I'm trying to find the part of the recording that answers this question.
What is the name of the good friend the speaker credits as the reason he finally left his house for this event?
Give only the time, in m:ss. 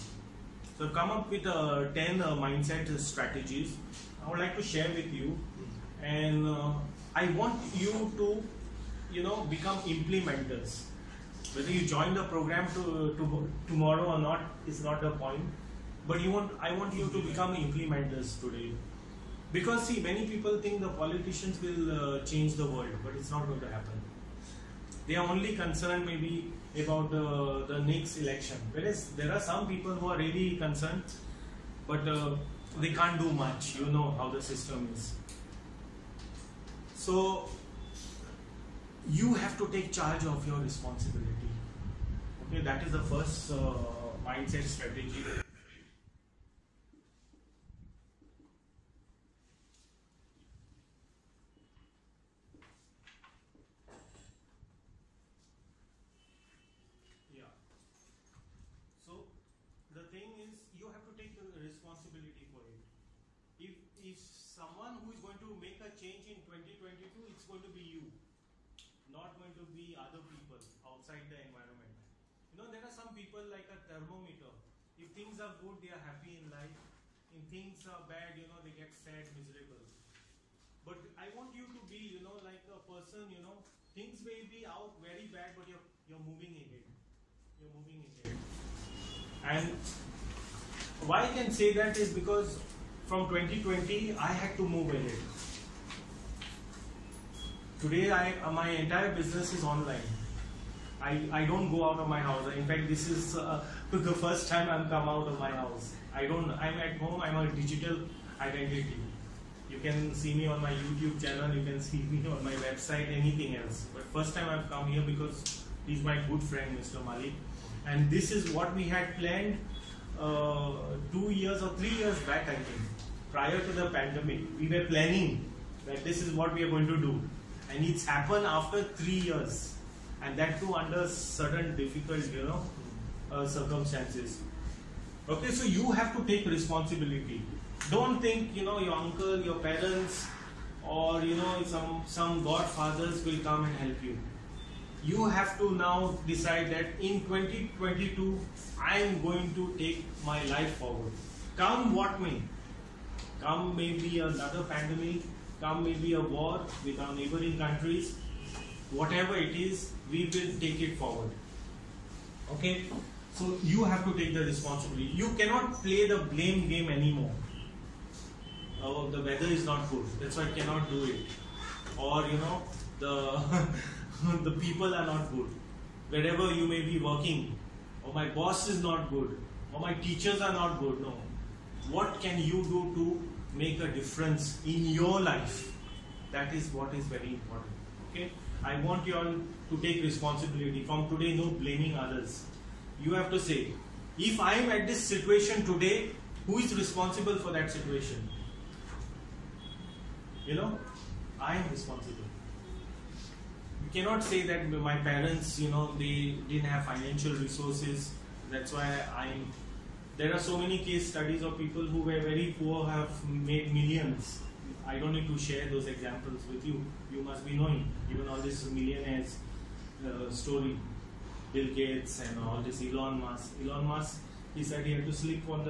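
1:56.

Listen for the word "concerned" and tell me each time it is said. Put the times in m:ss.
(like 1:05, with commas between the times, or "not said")
0:25, 0:30.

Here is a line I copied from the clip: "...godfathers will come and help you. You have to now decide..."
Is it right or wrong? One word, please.
right.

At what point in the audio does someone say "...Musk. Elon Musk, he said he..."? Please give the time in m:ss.
3:43.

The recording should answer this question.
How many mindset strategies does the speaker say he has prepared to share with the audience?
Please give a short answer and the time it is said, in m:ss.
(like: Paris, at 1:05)
10, at 0:01.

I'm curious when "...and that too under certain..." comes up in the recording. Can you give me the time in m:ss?
2:10.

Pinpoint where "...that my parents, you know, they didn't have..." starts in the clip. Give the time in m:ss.
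3:24.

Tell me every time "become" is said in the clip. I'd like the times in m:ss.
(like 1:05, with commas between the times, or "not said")
0:09, 0:17.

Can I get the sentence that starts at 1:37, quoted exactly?
Today, I, my entire business is online.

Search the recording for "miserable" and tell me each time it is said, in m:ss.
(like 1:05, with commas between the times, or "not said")
1:19.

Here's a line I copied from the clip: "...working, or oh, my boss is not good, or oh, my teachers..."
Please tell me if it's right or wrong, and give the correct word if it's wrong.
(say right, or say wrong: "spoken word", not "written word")
right.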